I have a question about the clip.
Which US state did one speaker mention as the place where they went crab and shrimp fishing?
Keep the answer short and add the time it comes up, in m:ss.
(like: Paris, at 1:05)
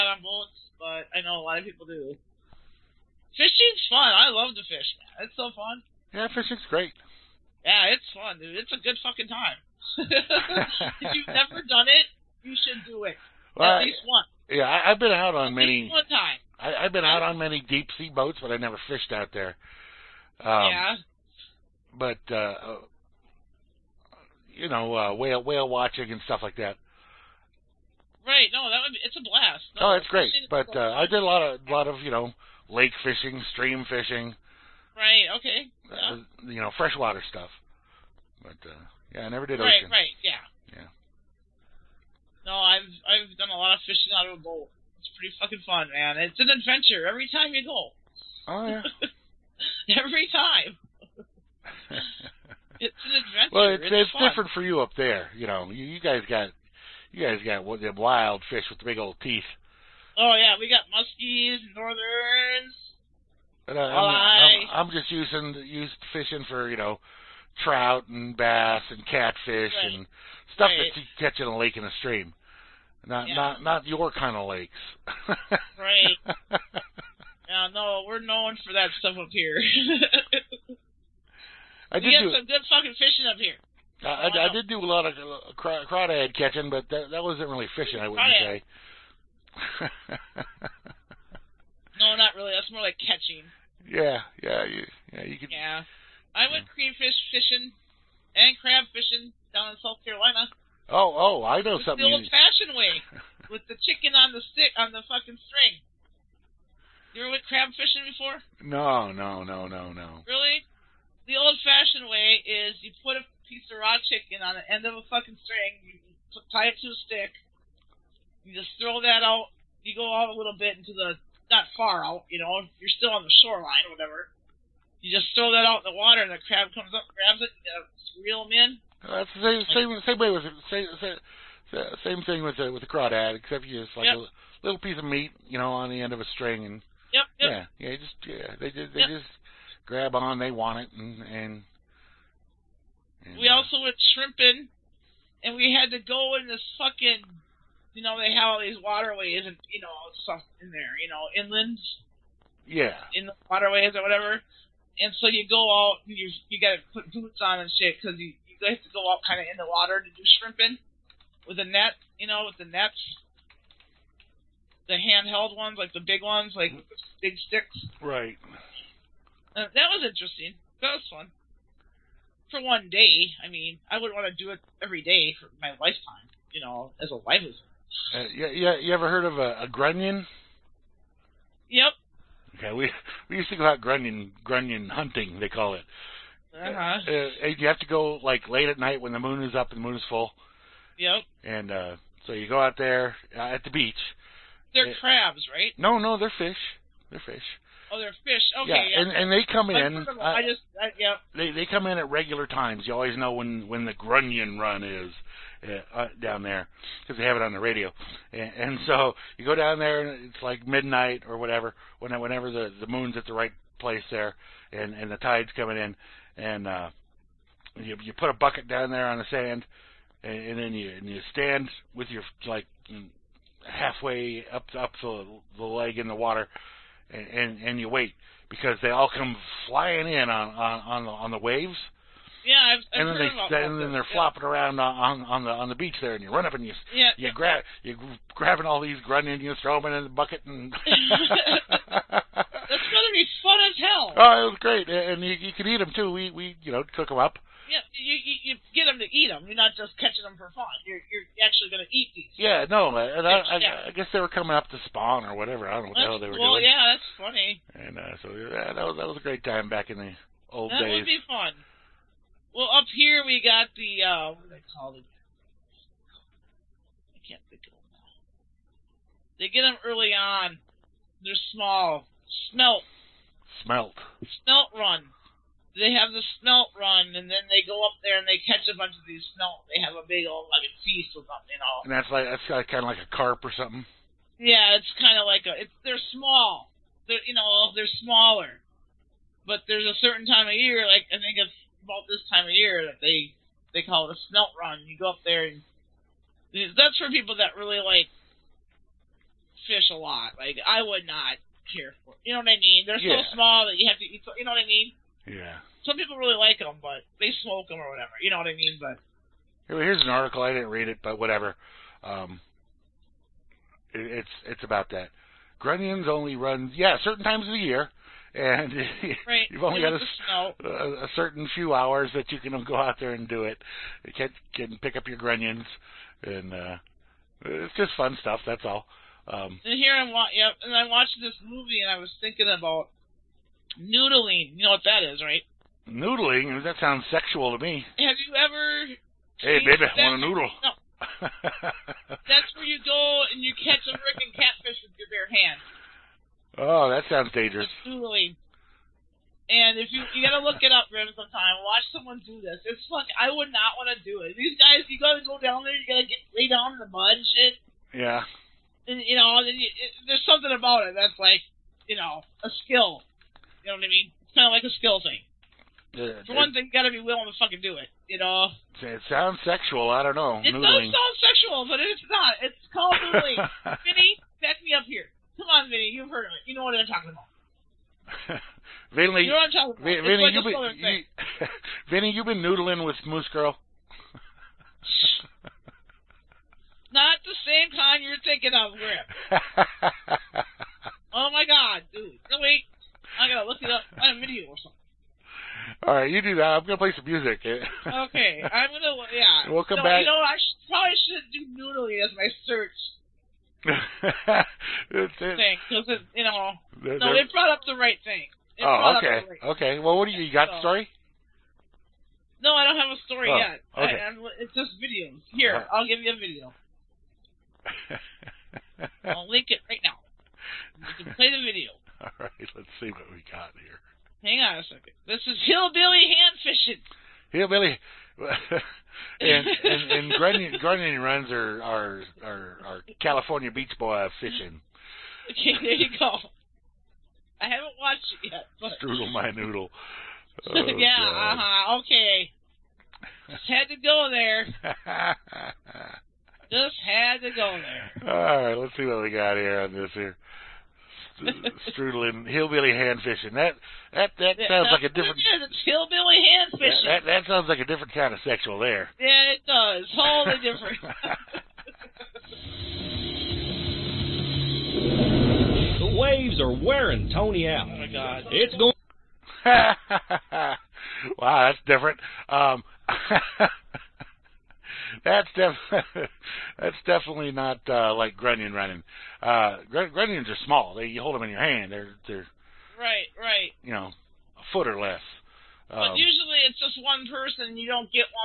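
South Carolina, at 1:39.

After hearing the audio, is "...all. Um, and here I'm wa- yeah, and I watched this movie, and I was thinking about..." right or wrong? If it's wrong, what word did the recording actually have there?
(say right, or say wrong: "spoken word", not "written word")
right.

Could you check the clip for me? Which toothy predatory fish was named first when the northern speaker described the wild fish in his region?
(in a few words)
Muskies.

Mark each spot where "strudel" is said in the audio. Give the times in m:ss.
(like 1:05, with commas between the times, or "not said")
7:18, 7:31.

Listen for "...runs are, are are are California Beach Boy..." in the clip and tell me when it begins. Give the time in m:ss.
7:11.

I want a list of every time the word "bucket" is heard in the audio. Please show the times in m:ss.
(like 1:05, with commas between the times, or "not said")
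3:38, 4:00.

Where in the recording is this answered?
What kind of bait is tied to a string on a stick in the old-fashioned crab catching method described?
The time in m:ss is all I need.
1:53.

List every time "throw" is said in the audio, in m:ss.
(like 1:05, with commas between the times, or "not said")
1:58, 2:05, 3:59.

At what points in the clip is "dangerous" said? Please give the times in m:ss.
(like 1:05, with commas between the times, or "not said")
5:47.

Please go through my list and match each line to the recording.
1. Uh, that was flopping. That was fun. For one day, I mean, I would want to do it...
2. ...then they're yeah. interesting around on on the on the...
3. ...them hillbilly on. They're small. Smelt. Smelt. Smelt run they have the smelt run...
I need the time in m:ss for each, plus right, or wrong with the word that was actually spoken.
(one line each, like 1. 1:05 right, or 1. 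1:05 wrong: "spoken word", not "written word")
1. 2:49 wrong: "interesting", not "flopping"
2. 3:53 wrong: "flopping", not "interesting"
3. 4:29 wrong: "early", not "hillbilly".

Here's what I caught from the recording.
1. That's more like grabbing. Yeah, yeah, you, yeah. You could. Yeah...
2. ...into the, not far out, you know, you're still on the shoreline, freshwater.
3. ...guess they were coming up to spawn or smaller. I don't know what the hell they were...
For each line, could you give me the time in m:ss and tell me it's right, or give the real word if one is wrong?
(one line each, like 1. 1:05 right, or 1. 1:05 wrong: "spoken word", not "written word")
1. 1:32 wrong: "catching", not "grabbing"
2. 2:00 wrong: "whatever", not "freshwater"
3. 4:13 wrong: "whatever", not "smaller".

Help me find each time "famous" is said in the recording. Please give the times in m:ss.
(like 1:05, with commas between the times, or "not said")
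not said.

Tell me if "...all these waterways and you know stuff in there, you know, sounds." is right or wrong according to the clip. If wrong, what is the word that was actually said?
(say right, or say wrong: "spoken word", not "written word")
wrong: "inlands", not "sounds".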